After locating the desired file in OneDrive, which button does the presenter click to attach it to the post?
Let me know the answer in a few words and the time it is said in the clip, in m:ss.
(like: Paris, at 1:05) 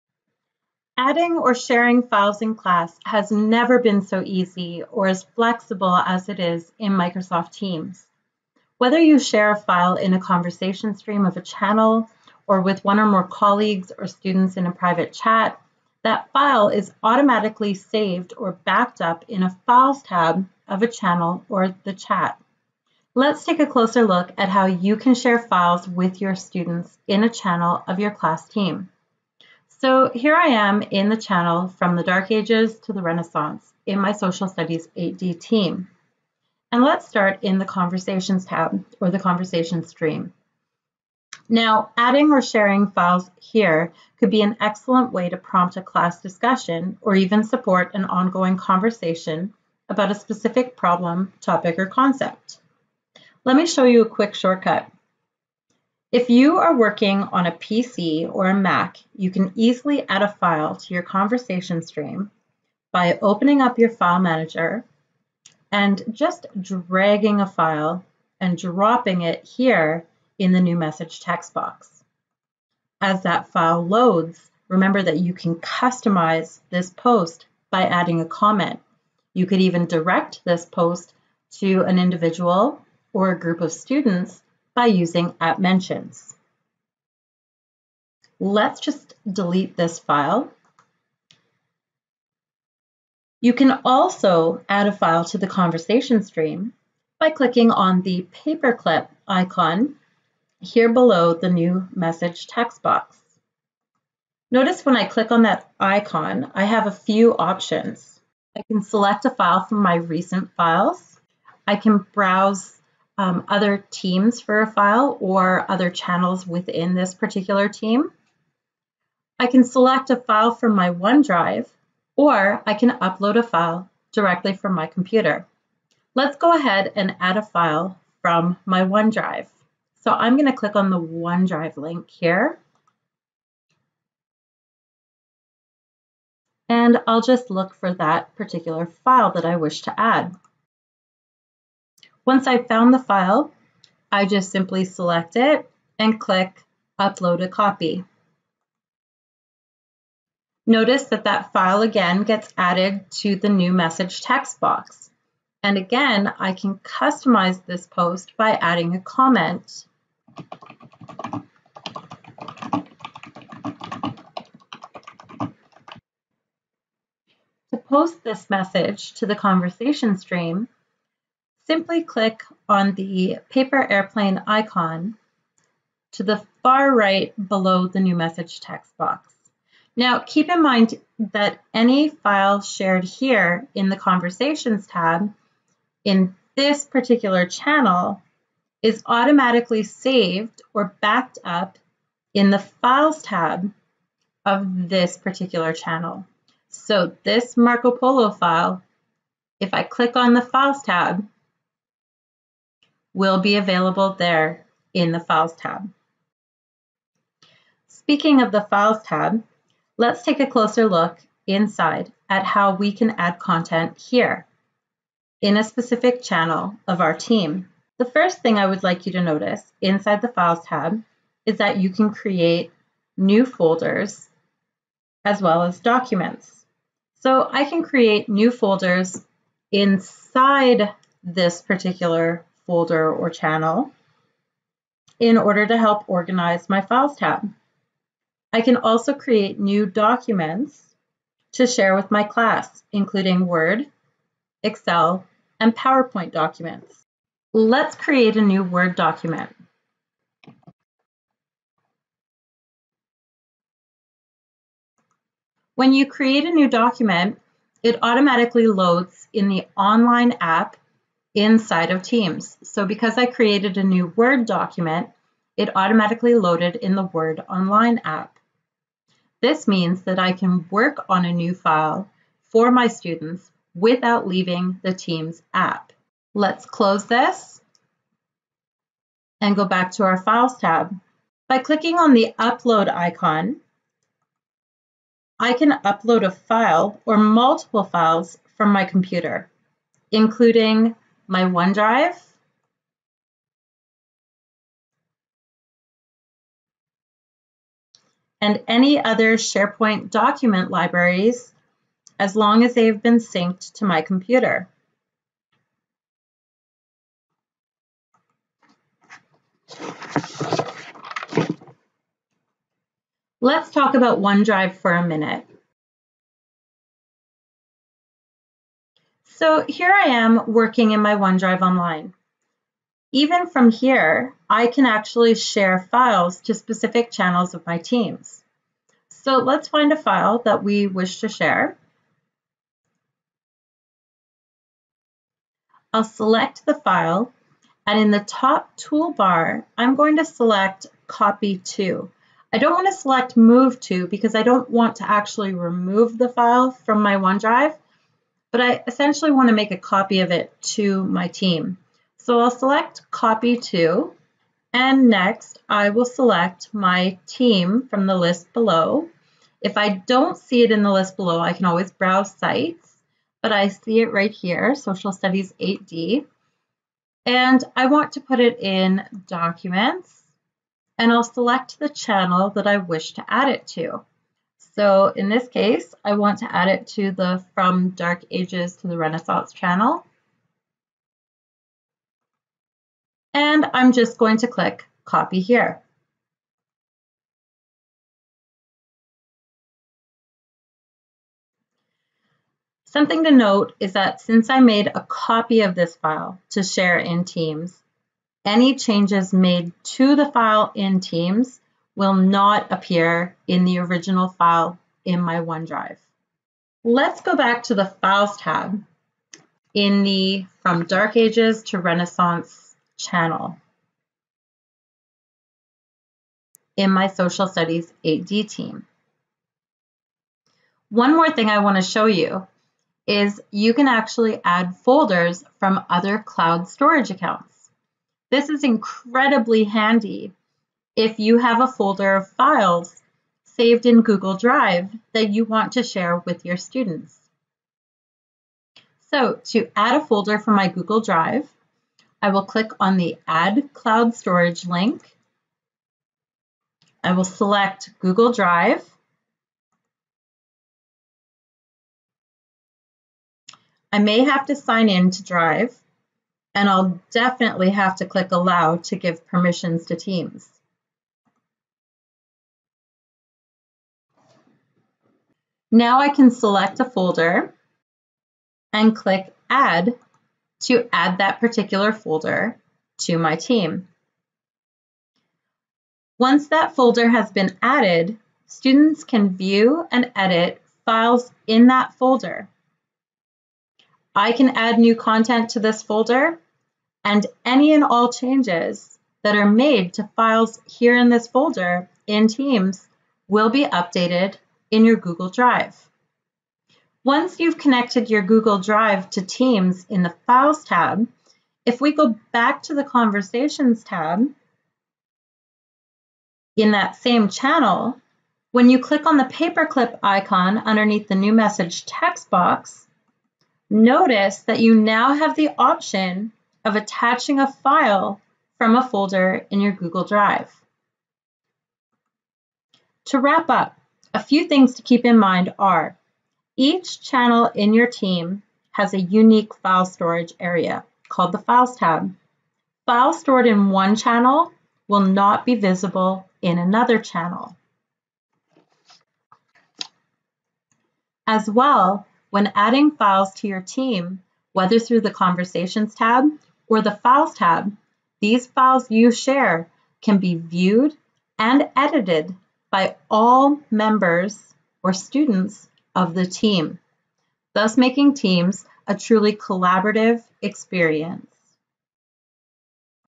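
Upload a Copy, at 2:26.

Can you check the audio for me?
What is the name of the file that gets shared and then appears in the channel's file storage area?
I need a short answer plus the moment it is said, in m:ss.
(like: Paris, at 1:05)
Marco Polo, at 3:17.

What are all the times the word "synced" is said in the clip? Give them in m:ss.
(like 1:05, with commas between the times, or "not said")
5:03.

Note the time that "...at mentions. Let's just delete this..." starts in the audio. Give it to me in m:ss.
1:25.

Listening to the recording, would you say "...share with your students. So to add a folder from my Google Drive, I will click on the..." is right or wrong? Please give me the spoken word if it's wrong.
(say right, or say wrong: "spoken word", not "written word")
right.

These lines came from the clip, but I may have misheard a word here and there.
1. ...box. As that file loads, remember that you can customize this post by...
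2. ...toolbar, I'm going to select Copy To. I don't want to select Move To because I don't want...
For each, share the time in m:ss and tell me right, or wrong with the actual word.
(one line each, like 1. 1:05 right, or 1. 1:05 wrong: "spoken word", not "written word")
1. 1:11 right
2. 5:38 right.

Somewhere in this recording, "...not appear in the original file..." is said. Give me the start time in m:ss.
6:42.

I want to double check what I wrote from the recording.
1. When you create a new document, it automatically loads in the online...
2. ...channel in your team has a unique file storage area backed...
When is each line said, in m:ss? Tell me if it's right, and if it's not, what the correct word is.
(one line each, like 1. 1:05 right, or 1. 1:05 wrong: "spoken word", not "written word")
1. 4:15 right
2. 8:47 wrong: "called", not "backed".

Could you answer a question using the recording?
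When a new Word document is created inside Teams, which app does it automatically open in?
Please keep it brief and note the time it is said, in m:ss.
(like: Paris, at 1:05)
Word Online, at 4:27.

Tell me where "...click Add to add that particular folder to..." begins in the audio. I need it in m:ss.
7:48.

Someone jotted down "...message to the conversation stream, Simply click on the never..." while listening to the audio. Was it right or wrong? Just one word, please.
wrong.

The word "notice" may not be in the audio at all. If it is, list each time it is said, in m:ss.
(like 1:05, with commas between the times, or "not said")
1:44, 2:30, 3:39, 8:33.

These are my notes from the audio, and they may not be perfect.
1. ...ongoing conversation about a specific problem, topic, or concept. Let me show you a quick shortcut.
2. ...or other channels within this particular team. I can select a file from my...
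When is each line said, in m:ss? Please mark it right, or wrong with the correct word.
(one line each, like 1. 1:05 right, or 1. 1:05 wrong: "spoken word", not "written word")
1. 0:48 right
2. 1:55 right.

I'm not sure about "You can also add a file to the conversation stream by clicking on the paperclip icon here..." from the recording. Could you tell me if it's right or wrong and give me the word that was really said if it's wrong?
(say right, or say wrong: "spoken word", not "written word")
right.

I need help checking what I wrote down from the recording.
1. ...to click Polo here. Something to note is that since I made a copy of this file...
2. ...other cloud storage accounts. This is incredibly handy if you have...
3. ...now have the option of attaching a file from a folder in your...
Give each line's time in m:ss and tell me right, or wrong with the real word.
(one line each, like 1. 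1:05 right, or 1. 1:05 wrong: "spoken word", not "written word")
1. 6:24 wrong: "Copy", not "Polo"
2. 7:05 right
3. 8:34 right.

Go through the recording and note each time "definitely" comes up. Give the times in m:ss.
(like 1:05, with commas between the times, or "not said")
7:37.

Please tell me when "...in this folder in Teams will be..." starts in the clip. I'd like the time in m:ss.
8:10.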